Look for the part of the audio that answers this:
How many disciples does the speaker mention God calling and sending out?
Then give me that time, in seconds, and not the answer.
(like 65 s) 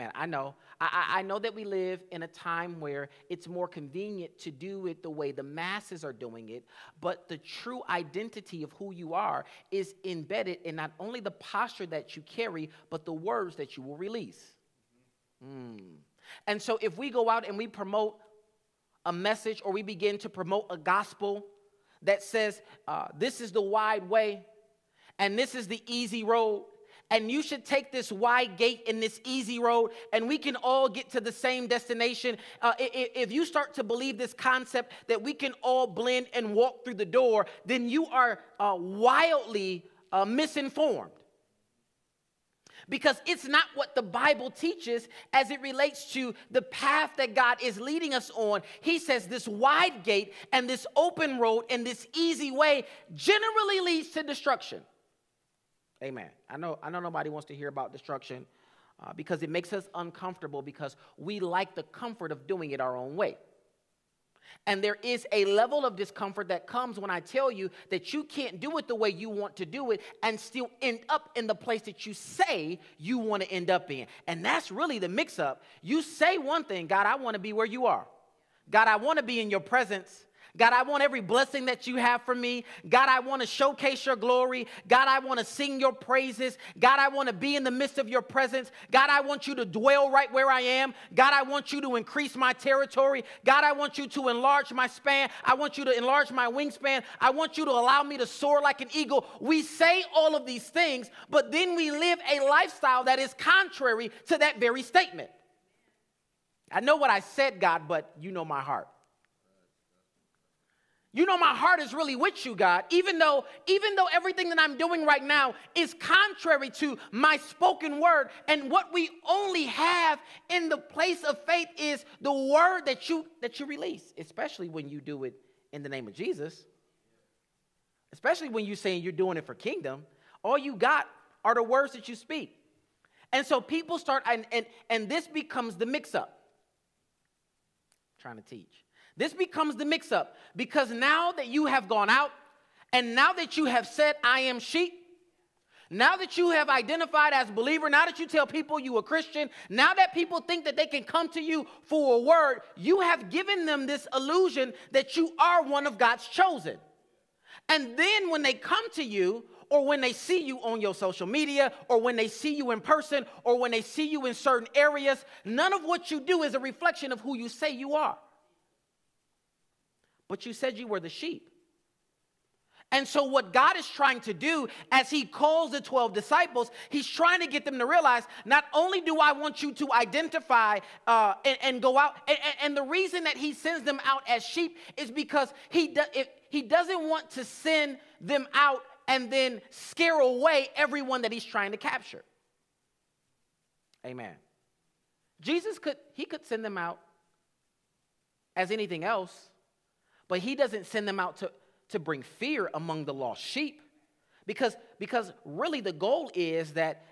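175 s.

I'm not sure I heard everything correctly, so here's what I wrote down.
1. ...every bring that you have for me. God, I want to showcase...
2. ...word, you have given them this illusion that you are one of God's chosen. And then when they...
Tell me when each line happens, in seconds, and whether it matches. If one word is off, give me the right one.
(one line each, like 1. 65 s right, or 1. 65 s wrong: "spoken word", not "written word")
1. 81 s wrong: "blessing", not "bring"
2. 152 s right.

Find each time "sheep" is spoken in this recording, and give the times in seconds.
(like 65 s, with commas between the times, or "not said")
144 s, 171 s, 184 s, 203 s.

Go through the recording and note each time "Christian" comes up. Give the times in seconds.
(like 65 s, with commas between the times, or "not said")
149 s.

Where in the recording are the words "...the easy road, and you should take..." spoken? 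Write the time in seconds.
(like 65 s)
25 s.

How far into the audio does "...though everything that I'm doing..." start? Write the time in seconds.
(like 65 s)
113 s.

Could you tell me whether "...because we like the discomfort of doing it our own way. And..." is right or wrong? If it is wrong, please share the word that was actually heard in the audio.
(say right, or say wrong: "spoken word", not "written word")
wrong: "comfort", not "discomfort".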